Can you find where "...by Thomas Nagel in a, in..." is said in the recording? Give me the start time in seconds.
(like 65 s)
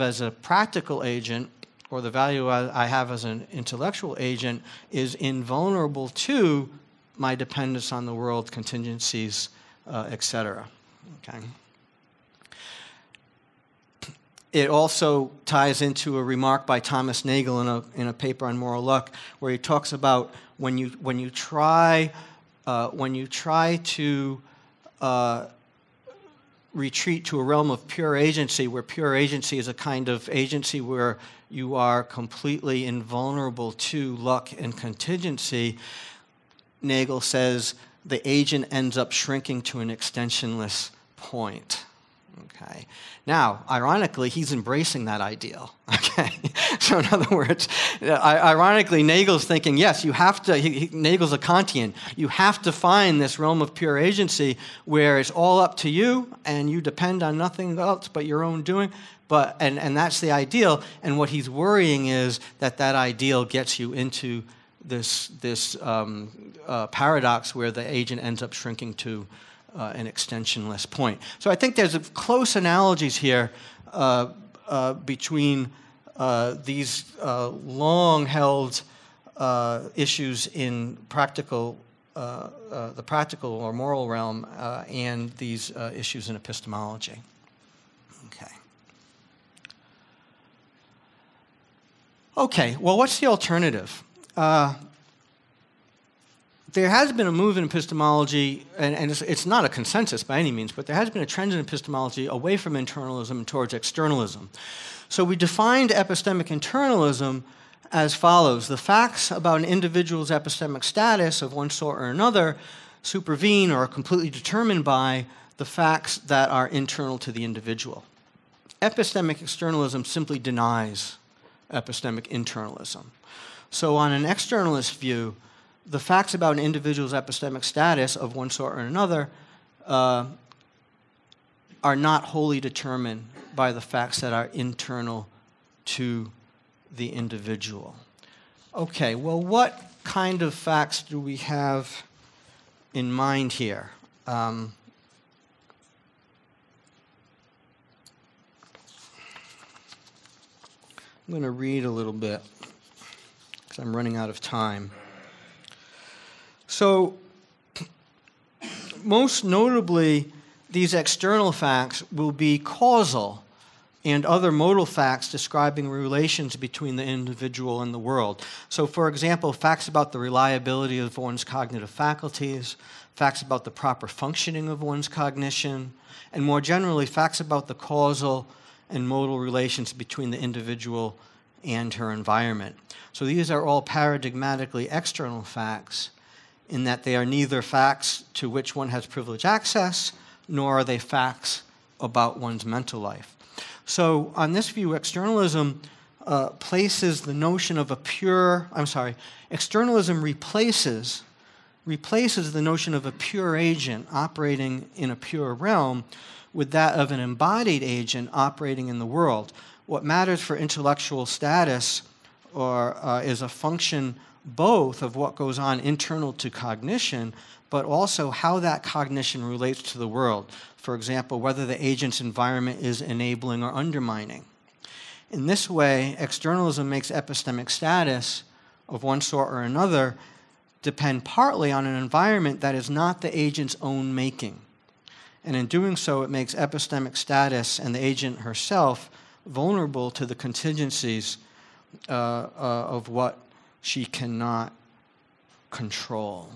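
16 s.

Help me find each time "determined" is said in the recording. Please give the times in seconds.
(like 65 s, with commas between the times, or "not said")
114 s, 132 s.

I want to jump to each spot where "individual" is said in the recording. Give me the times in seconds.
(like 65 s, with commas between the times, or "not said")
109 s, 117 s, 126 s, 137 s, 167 s, 180 s.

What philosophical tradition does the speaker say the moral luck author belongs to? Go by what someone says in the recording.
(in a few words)
Kantian.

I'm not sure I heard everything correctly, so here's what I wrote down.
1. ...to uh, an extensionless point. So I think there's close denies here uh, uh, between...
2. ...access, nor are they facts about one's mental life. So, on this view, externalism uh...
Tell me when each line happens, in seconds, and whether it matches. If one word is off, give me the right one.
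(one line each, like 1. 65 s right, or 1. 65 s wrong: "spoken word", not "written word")
1. 69 s wrong: "analogies", not "denies"
2. 189 s right.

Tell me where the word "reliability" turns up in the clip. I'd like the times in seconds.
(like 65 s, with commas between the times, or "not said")
170 s.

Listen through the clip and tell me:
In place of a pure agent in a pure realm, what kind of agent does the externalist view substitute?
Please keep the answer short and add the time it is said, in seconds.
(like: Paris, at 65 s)
An embodied agent, at 207 s.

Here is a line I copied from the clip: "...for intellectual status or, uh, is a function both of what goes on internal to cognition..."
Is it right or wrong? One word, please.
right.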